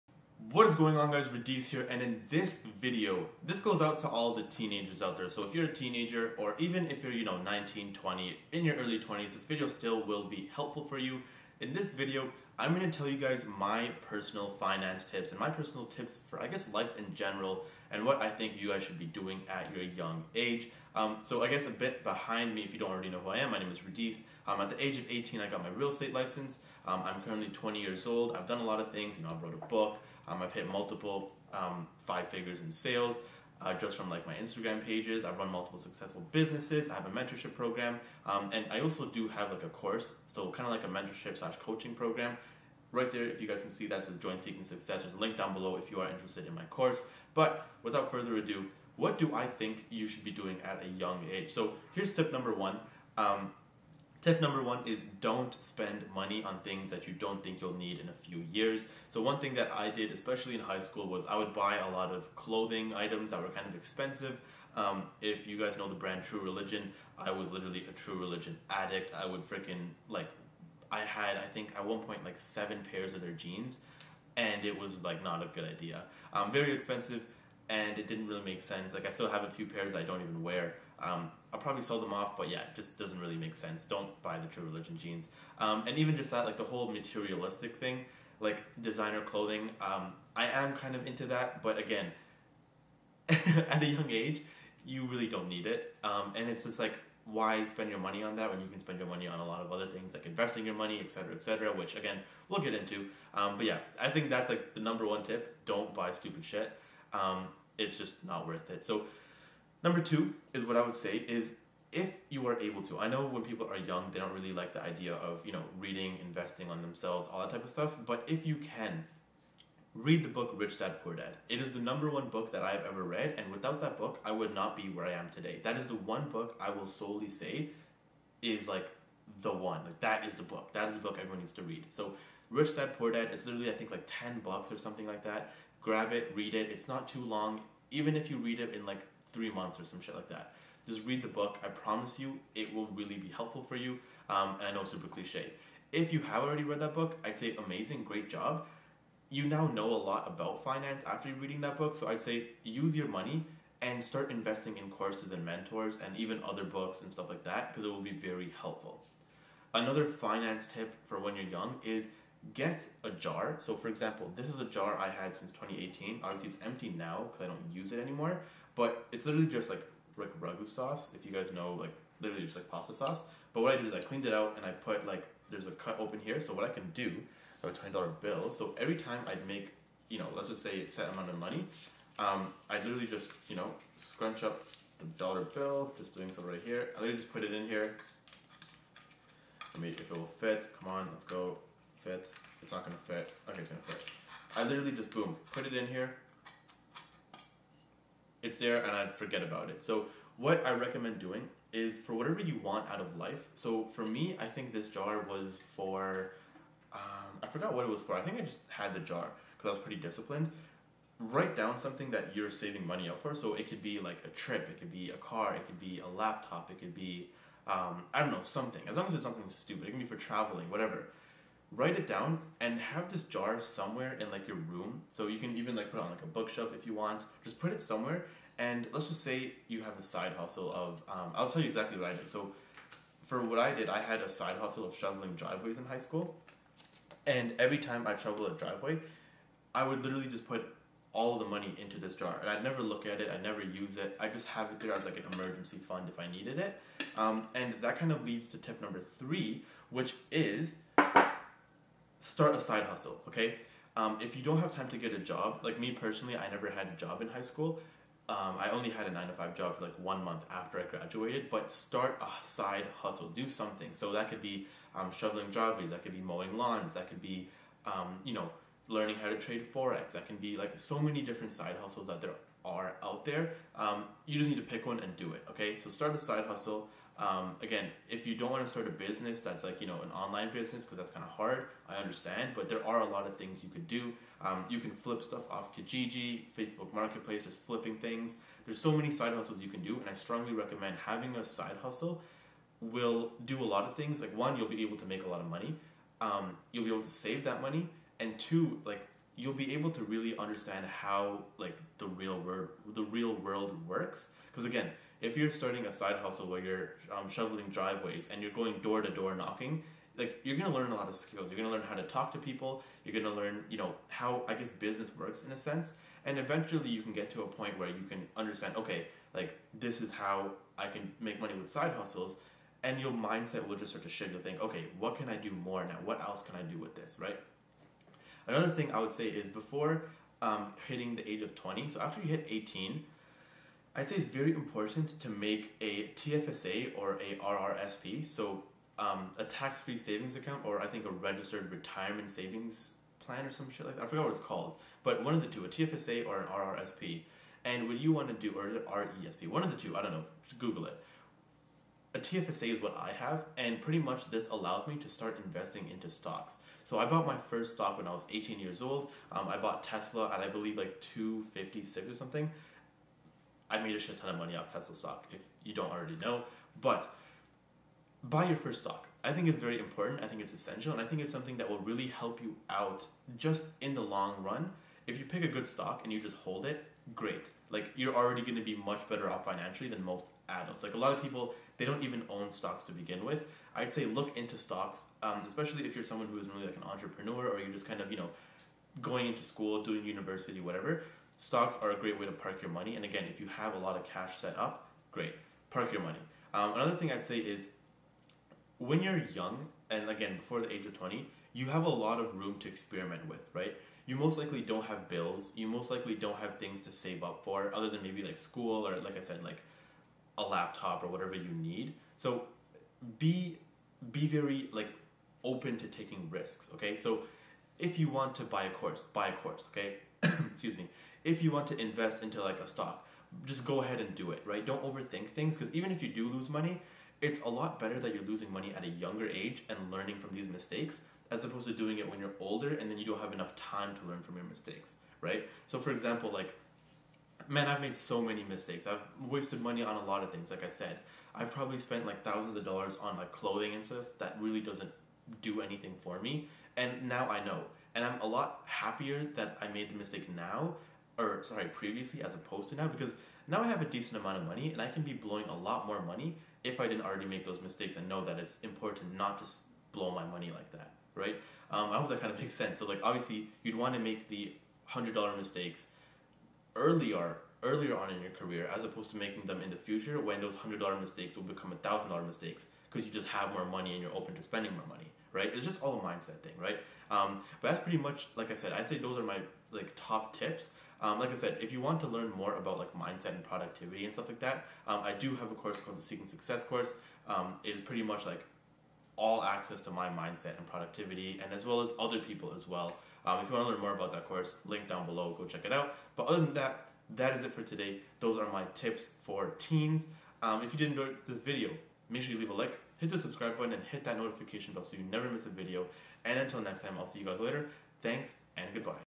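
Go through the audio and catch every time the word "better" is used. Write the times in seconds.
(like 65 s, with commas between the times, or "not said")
379 s, 427 s.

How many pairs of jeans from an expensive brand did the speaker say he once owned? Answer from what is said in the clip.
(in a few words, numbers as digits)
7.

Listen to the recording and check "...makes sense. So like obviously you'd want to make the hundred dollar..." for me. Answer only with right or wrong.
right.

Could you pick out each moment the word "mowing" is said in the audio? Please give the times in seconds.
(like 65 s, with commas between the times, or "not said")
266 s.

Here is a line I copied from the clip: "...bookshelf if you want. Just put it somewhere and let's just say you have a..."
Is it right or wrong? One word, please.
right.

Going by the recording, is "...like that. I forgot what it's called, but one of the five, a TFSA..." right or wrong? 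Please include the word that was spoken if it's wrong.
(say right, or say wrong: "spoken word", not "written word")
wrong: "two", not "five".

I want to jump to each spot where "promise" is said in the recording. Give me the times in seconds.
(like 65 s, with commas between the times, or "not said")
141 s.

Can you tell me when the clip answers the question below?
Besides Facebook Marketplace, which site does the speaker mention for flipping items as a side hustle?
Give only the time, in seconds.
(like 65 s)
285 s.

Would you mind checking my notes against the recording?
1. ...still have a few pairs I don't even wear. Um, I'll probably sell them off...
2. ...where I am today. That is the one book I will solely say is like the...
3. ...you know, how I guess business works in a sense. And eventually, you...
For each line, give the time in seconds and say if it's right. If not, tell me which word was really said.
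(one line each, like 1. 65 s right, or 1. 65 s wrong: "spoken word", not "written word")
1. 79 s right
2. 124 s right
3. 313 s right.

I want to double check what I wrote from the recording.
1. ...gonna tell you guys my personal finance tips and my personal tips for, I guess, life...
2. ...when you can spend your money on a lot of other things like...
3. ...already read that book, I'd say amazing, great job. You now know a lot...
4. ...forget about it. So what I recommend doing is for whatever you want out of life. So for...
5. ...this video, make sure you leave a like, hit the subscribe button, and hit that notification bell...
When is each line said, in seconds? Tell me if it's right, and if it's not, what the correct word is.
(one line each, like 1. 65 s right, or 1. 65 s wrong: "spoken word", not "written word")
1. 12 s right
2. 98 s right
3. 146 s right
4. 199 s right
5. 501 s right.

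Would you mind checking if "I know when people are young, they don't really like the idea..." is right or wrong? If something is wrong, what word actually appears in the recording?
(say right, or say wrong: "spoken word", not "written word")
right.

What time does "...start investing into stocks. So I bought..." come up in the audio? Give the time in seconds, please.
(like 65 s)
355 s.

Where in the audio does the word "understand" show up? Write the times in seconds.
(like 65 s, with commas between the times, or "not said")
281 s, 300 s, 318 s.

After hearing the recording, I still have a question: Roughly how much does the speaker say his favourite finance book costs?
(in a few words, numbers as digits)
10 bucks.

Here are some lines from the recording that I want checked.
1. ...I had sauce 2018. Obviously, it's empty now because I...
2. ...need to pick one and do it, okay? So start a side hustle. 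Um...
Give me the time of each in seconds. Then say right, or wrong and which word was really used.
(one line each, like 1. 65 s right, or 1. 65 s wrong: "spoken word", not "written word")
1. 164 s wrong: "since", not "sauce"
2. 274 s right.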